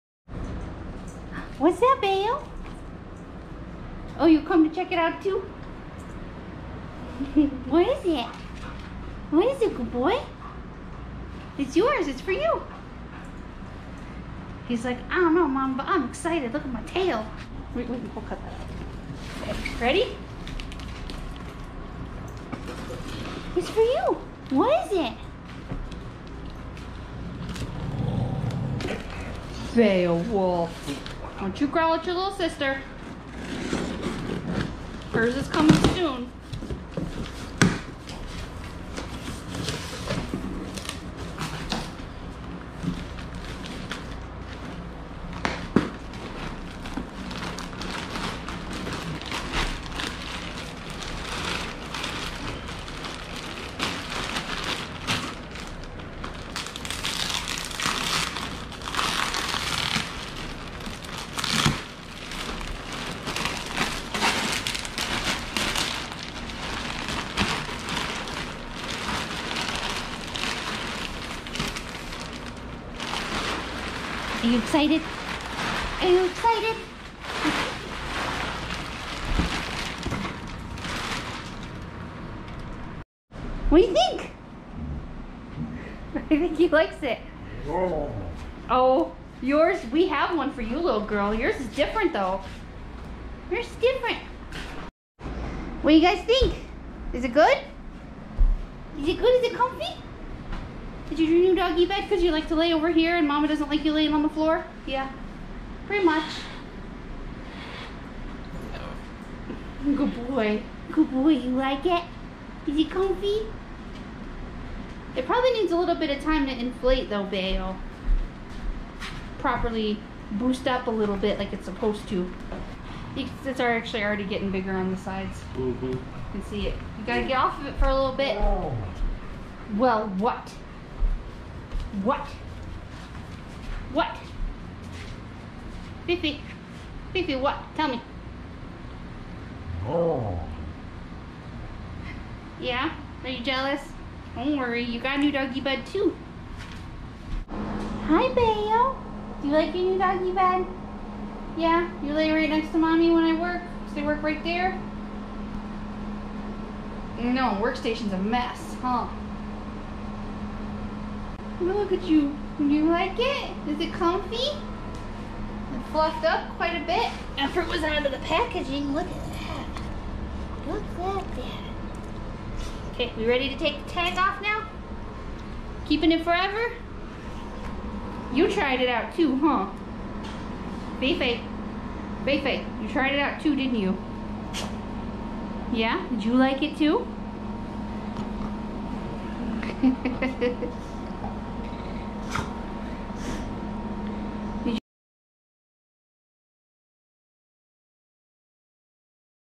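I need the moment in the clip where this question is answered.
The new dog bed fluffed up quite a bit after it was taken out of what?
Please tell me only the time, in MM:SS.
02:48.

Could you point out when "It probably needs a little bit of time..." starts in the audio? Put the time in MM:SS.
01:55.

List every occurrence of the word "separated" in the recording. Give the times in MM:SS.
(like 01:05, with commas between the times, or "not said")
not said.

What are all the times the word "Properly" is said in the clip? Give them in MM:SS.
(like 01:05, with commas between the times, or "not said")
01:59.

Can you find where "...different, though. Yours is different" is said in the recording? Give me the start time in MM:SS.
01:31.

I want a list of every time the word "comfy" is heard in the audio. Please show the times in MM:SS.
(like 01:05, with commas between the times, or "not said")
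01:39, 01:52, 02:43.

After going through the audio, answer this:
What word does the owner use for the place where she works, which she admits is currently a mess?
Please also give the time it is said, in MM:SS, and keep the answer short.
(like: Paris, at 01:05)
workstation, at 02:37.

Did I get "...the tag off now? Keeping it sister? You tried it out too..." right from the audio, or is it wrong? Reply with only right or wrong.
wrong.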